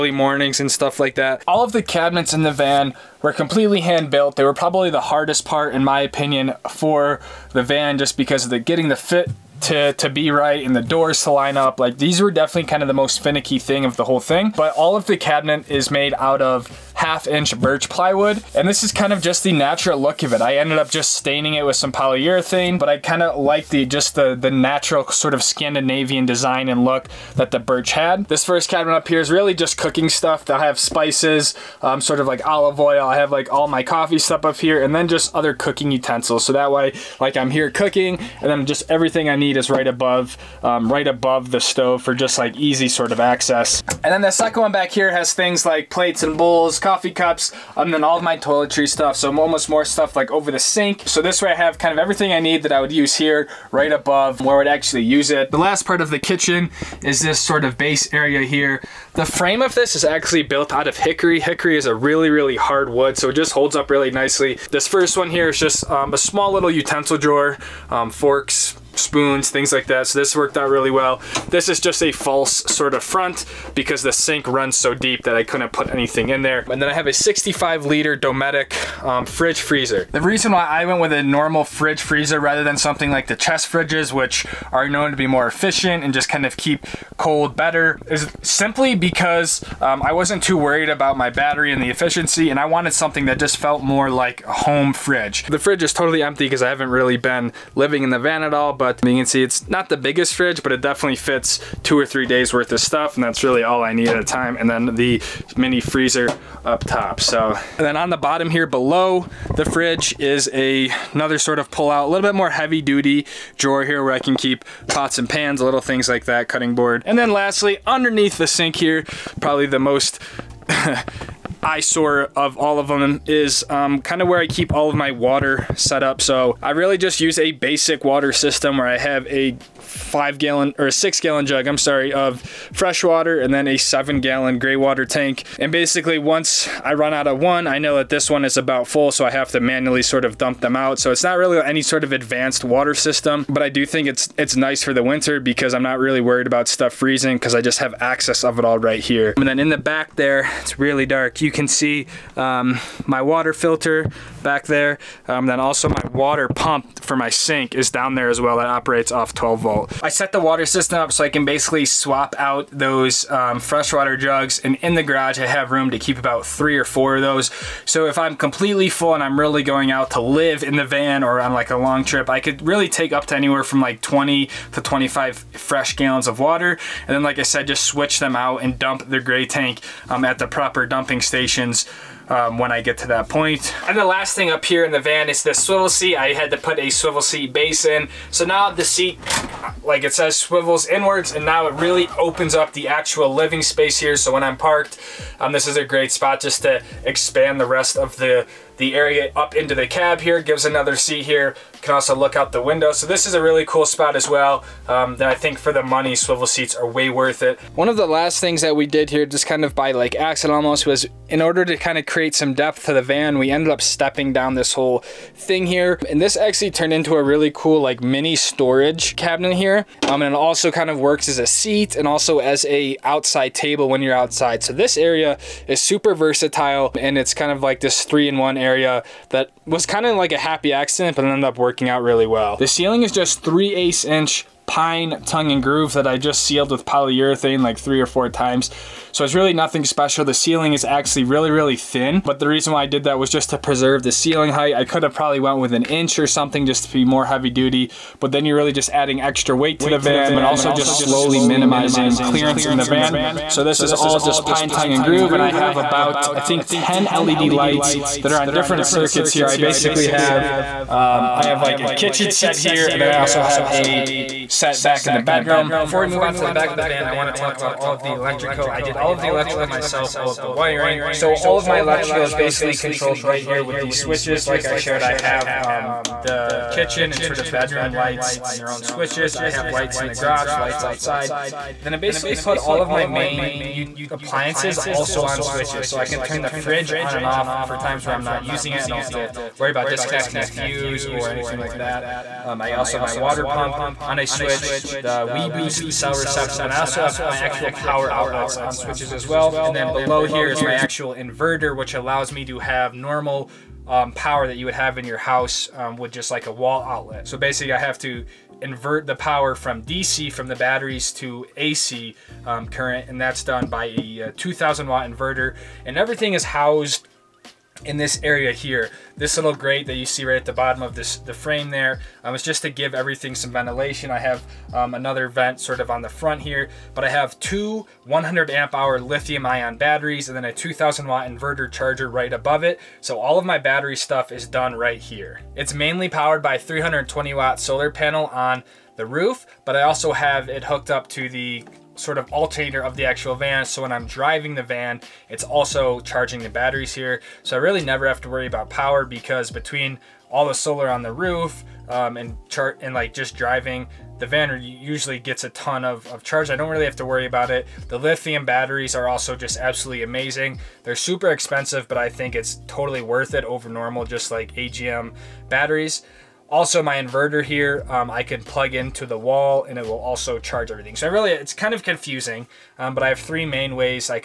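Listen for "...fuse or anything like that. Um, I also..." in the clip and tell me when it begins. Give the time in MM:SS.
04:50.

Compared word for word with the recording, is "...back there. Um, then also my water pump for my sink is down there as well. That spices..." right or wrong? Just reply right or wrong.
wrong.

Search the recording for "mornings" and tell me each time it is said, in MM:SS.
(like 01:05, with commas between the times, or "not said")
00:00.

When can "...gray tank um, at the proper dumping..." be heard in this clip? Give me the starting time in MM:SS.
02:59.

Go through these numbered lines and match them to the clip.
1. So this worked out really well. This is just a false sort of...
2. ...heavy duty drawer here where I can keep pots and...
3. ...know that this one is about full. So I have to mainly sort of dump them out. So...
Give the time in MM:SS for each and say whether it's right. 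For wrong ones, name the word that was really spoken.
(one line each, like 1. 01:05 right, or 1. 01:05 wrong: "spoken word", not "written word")
1. 01:10 right
2. 01:52 right
3. 02:17 wrong: "manually", not "mainly".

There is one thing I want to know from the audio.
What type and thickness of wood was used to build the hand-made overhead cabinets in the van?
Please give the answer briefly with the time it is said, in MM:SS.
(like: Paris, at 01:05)
half inch birch plywood, at 00:17.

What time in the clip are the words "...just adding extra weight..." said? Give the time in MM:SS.
04:08.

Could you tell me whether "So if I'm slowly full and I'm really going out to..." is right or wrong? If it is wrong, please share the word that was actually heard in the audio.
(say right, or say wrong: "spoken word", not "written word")
wrong: "completely", not "slowly".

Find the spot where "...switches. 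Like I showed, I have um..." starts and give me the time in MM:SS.
04:33.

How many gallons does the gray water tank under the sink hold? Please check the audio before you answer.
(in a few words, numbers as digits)
7 gallons.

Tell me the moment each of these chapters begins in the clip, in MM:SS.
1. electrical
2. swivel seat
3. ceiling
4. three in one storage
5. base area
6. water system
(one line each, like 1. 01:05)
1. 04:25
2. 03:03
3. 03:52
4. 03:27
5. 00:54
6. 01:56.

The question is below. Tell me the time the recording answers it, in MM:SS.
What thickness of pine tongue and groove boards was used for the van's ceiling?
03:53.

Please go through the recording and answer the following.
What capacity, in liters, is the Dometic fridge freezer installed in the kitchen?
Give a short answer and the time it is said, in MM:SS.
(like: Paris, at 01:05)
65 liters, at 01:17.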